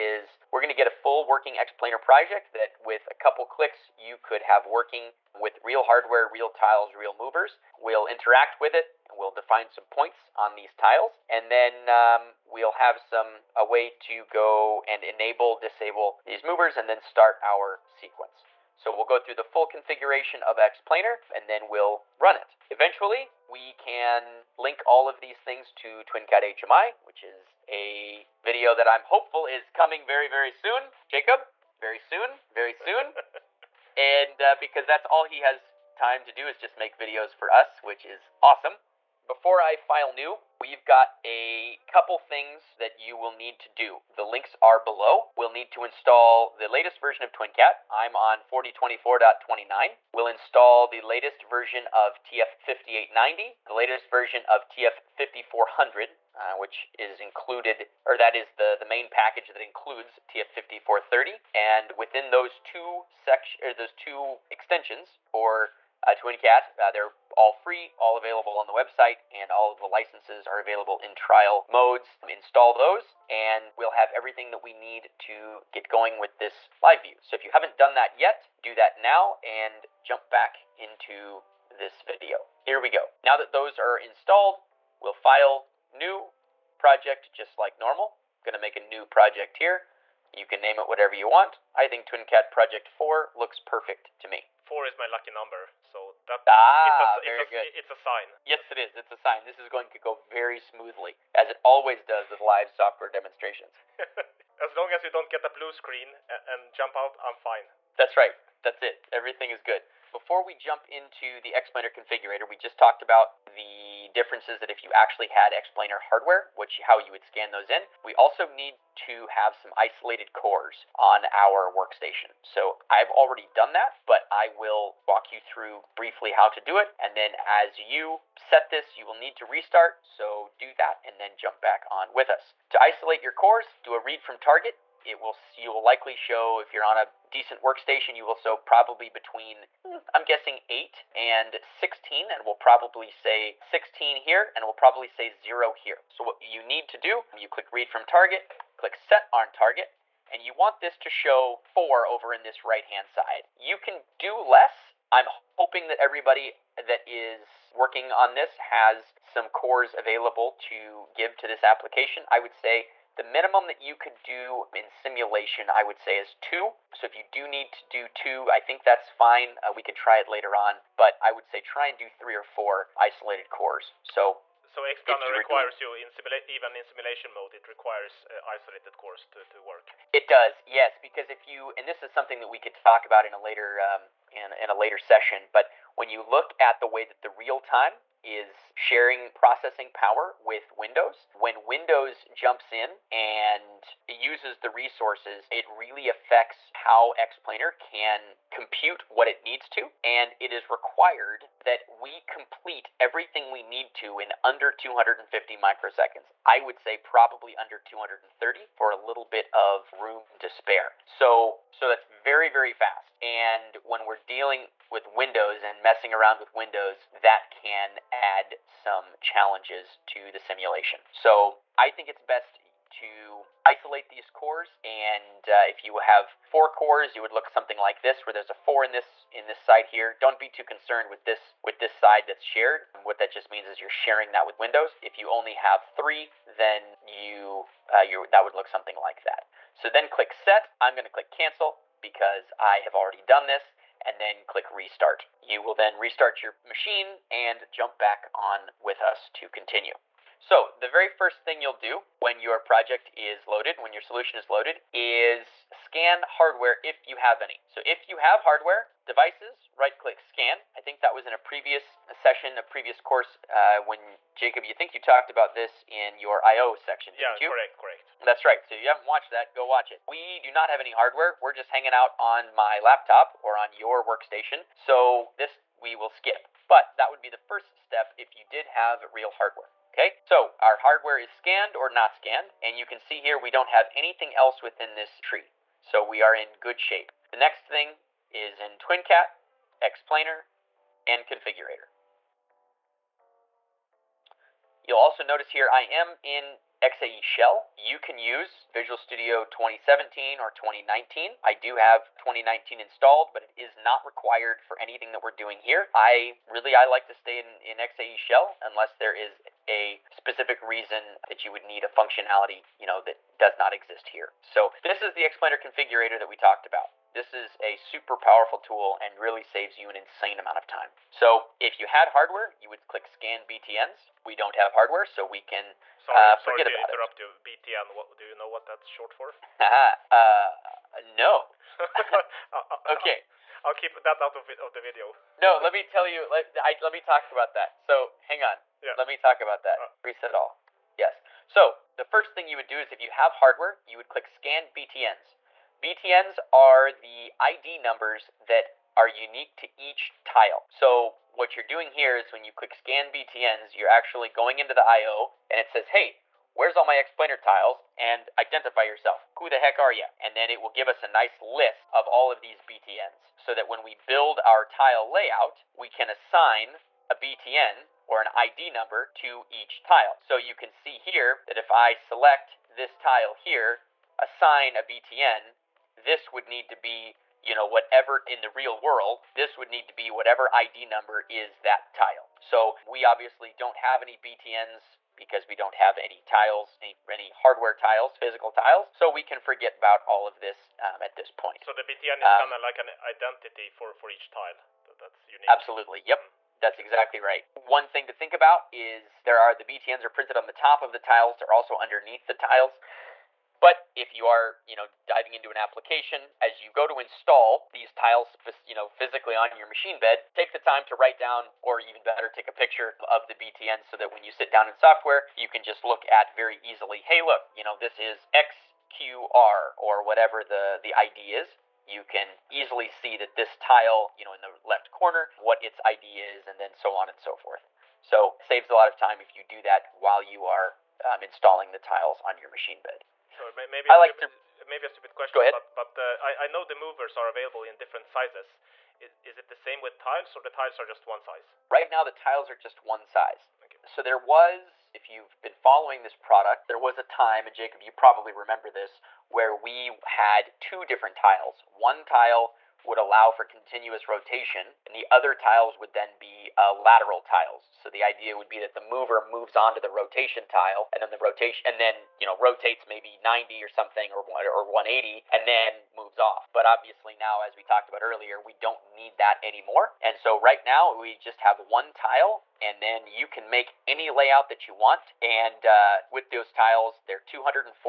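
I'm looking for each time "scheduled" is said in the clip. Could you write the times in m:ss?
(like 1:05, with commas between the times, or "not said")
not said.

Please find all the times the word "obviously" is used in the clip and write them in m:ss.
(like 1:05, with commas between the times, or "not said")
6:23, 7:46.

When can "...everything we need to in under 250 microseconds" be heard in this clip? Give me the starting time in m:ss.
3:22.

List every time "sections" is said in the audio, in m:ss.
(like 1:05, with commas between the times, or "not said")
1:03, 4:26.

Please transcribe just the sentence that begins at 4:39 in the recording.
Okay, so our hardware is scanned or not scanned, and you can see here we don't have anything else within this tree.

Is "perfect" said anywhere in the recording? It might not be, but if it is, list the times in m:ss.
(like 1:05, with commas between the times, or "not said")
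1:33.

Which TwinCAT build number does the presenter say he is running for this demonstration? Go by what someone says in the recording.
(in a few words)
4024.29.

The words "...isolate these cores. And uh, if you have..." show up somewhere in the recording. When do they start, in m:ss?
3:43.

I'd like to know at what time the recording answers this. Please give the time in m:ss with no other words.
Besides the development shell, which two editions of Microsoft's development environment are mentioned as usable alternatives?
4:58.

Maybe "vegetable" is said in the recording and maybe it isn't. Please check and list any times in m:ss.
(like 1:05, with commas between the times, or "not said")
not said.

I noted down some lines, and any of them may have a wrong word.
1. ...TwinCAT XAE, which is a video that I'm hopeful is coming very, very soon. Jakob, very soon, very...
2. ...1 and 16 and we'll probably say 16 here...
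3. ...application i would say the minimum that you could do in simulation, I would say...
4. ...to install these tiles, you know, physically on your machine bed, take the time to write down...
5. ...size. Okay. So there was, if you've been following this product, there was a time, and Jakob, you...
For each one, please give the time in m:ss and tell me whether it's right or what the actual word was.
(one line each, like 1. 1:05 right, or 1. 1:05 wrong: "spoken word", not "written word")
1. 0:26 wrong: "HMI", not "XAE"
2. 2:20 wrong: "8", not "1"
3. 2:41 right
4. 6:46 right
5. 7:23 right.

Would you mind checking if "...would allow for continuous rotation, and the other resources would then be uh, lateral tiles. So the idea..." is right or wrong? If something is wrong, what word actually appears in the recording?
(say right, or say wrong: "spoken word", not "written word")
wrong: "tiles", not "resources".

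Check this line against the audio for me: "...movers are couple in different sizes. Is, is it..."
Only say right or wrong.
wrong.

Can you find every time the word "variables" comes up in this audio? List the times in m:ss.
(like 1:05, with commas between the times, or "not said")
not said.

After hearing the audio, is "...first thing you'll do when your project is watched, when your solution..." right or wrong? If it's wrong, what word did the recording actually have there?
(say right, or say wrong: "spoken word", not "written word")
wrong: "loaded", not "watched".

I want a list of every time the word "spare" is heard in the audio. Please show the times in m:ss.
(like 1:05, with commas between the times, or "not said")
3:30.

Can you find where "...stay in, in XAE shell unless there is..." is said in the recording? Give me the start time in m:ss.
5:07.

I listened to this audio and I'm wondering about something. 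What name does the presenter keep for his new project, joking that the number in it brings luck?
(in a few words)
TwinCAT Project 4.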